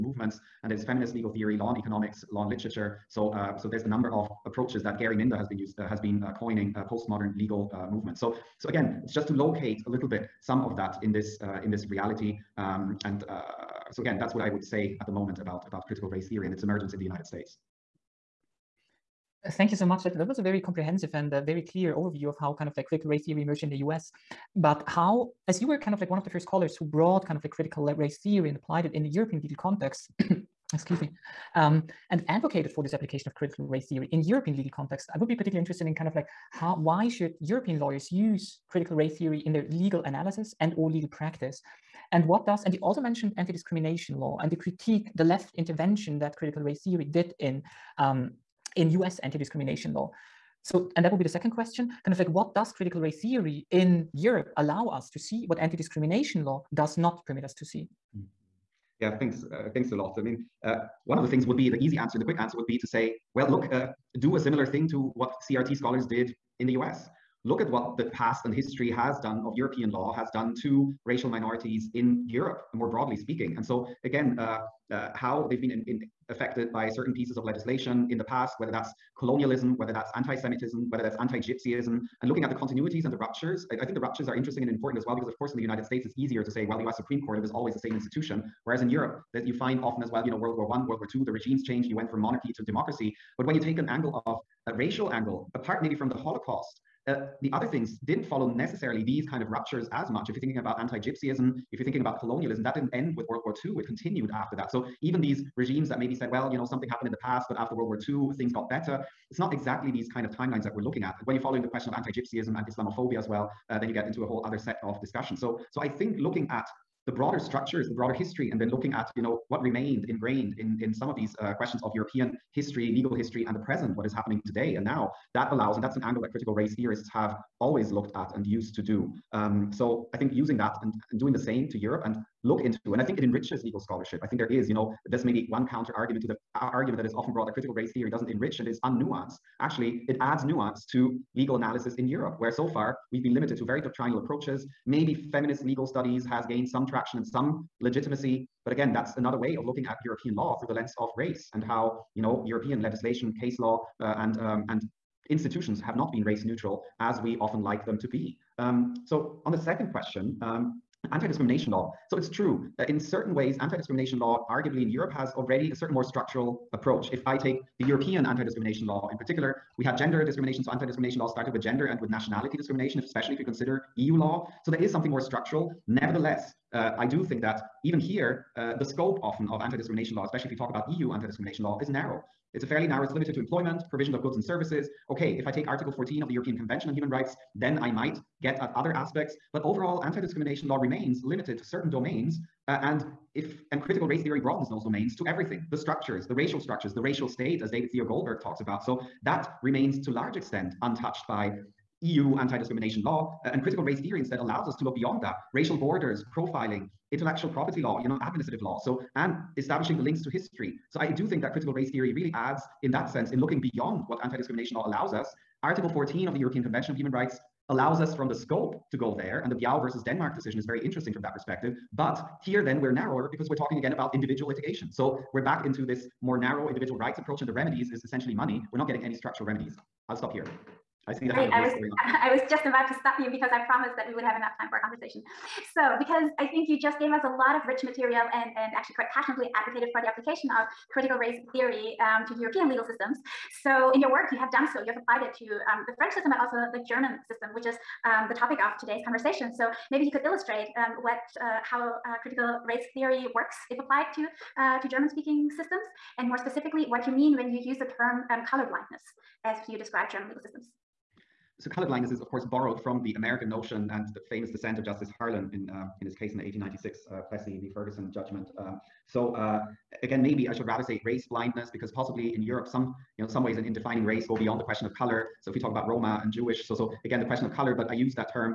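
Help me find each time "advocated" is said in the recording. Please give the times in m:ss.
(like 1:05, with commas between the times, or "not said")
0:32, 3:59.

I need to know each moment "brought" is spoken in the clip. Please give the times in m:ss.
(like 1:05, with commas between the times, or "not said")
0:26, 2:17.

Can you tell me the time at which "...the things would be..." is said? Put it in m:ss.
1:01.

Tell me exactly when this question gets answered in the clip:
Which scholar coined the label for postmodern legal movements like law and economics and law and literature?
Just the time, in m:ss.
0:04.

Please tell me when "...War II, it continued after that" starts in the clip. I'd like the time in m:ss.
1:43.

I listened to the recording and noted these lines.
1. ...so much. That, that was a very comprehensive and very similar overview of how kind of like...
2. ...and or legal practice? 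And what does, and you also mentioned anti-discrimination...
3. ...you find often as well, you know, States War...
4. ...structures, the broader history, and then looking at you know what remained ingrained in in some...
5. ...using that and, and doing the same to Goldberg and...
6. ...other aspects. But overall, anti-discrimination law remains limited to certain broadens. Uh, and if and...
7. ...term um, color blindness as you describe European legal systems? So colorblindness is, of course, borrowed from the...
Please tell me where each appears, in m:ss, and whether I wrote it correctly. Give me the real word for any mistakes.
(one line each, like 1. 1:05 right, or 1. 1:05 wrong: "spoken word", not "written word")
1. 0:19 wrong: "clear", not "similar"
2. 0:40 right
3. 1:29 wrong: "World", not "States"
4. 1:57 right
5. 2:10 wrong: "Europe", not "Goldberg"
6. 3:08 wrong: "domains", not "broadens"
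7. 4:17 wrong: "German", not "European".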